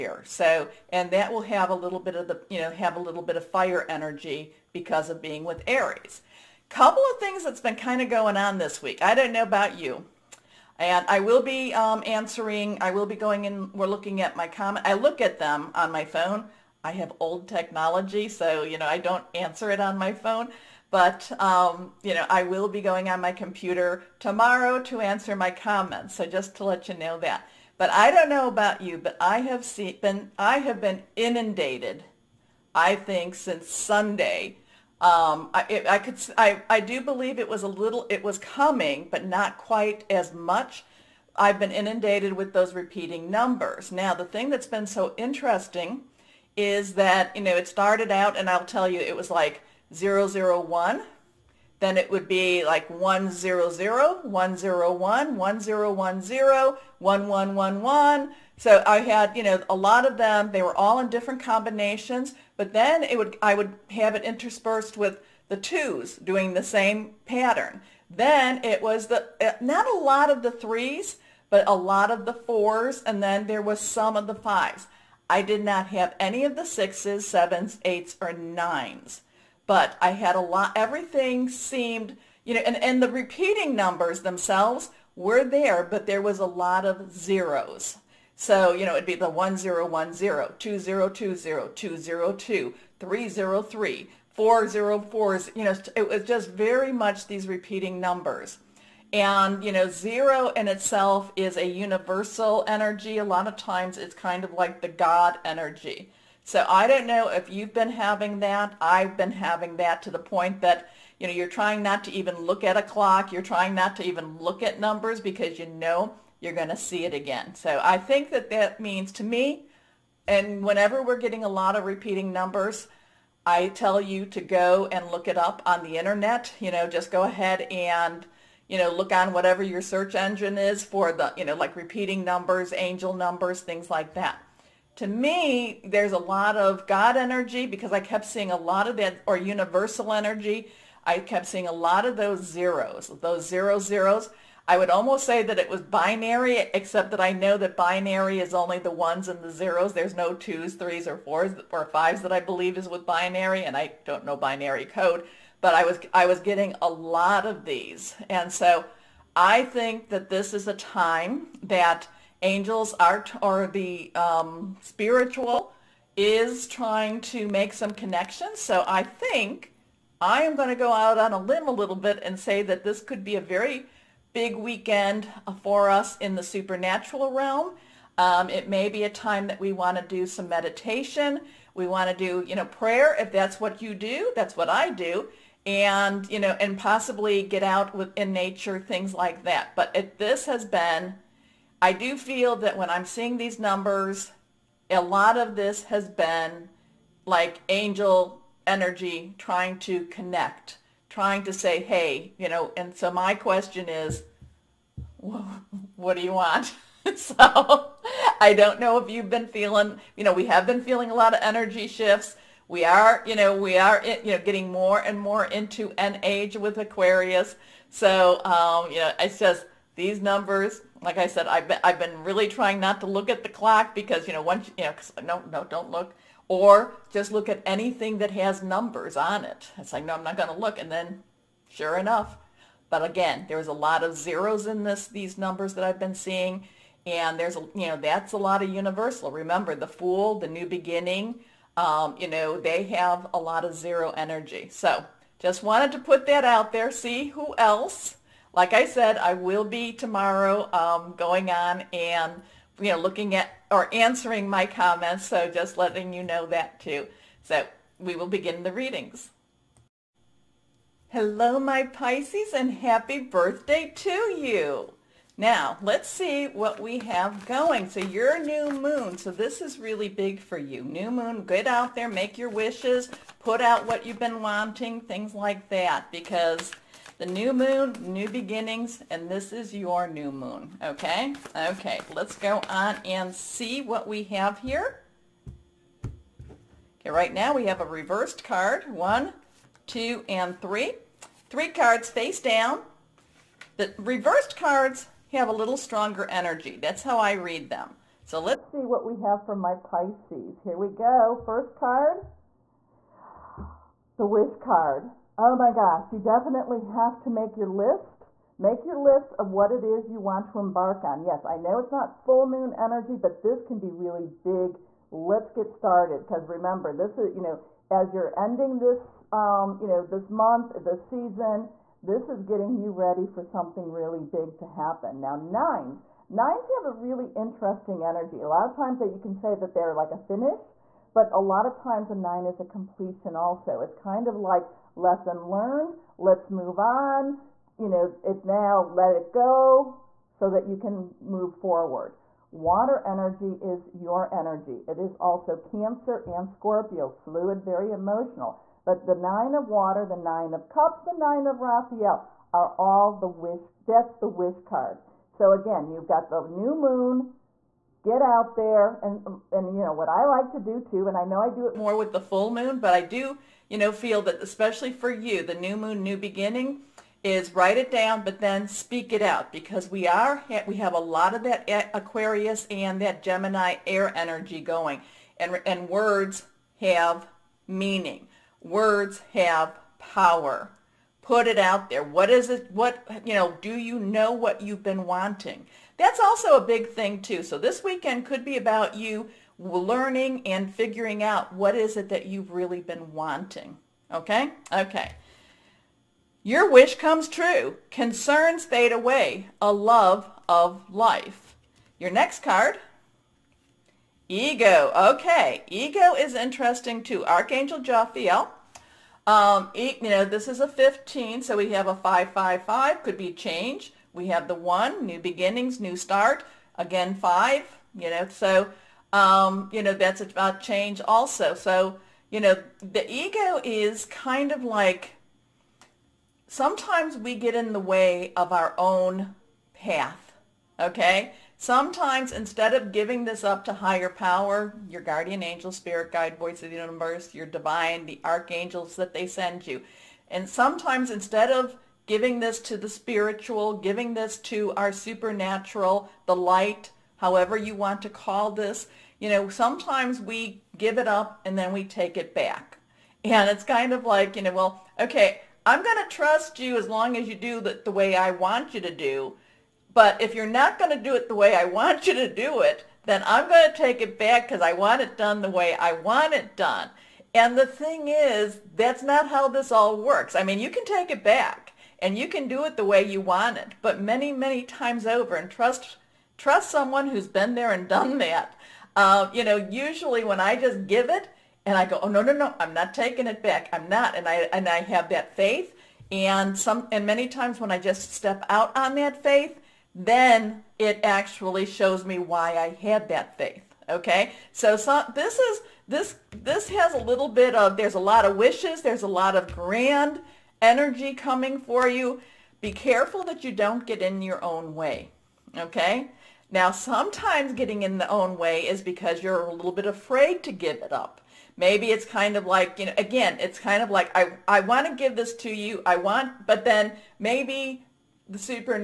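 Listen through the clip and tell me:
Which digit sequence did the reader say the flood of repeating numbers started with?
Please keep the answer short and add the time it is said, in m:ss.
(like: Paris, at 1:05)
001, at 0:49.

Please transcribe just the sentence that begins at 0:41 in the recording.
I've been inundated with those repeating numbers.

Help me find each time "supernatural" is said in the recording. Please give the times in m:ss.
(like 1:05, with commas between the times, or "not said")
2:56, 7:24.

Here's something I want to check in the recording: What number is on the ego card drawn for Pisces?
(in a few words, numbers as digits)
15.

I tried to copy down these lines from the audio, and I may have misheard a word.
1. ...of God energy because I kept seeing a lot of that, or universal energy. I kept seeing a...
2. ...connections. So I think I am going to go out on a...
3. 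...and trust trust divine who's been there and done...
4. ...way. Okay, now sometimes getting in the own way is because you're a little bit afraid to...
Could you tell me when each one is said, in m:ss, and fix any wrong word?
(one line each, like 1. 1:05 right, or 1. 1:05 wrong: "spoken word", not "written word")
1. 2:16 right
2. 2:47 right
3. 7:55 wrong: "someone", not "divine"
4. 8:24 right.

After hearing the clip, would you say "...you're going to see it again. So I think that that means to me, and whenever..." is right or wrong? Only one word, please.
right.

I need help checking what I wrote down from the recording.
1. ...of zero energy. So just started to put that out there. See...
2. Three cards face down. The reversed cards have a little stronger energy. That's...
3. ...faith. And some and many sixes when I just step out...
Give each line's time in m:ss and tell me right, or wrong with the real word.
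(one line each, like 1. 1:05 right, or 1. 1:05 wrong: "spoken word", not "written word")
1. 4:03 wrong: "wanted", not "started"
2. 4:51 right
3. 8:05 wrong: "times", not "sixes".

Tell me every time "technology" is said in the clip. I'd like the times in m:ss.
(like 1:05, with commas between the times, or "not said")
0:17.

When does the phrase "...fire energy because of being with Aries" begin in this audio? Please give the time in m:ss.
0:03.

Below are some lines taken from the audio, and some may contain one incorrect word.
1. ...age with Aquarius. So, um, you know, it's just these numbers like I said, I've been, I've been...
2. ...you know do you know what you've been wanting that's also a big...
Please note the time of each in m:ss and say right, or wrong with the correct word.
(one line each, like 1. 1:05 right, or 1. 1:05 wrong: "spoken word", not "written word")
1. 3:36 right
2. 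6:23 right.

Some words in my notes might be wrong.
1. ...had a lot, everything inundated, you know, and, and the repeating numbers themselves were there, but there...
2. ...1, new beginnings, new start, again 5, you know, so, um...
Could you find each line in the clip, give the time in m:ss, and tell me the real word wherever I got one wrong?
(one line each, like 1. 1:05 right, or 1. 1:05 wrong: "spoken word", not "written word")
1. 1:20 wrong: "seemed", not "inundated"
2. 6:54 right.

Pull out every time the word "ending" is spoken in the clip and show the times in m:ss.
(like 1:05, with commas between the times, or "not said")
5:18.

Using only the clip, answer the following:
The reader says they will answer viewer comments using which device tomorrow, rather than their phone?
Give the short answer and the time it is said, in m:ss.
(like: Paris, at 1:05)
computer, at 0:23.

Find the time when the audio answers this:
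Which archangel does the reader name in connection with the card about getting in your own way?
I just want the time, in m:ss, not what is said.
6:47.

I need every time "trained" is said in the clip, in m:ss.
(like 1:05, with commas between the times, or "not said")
not said.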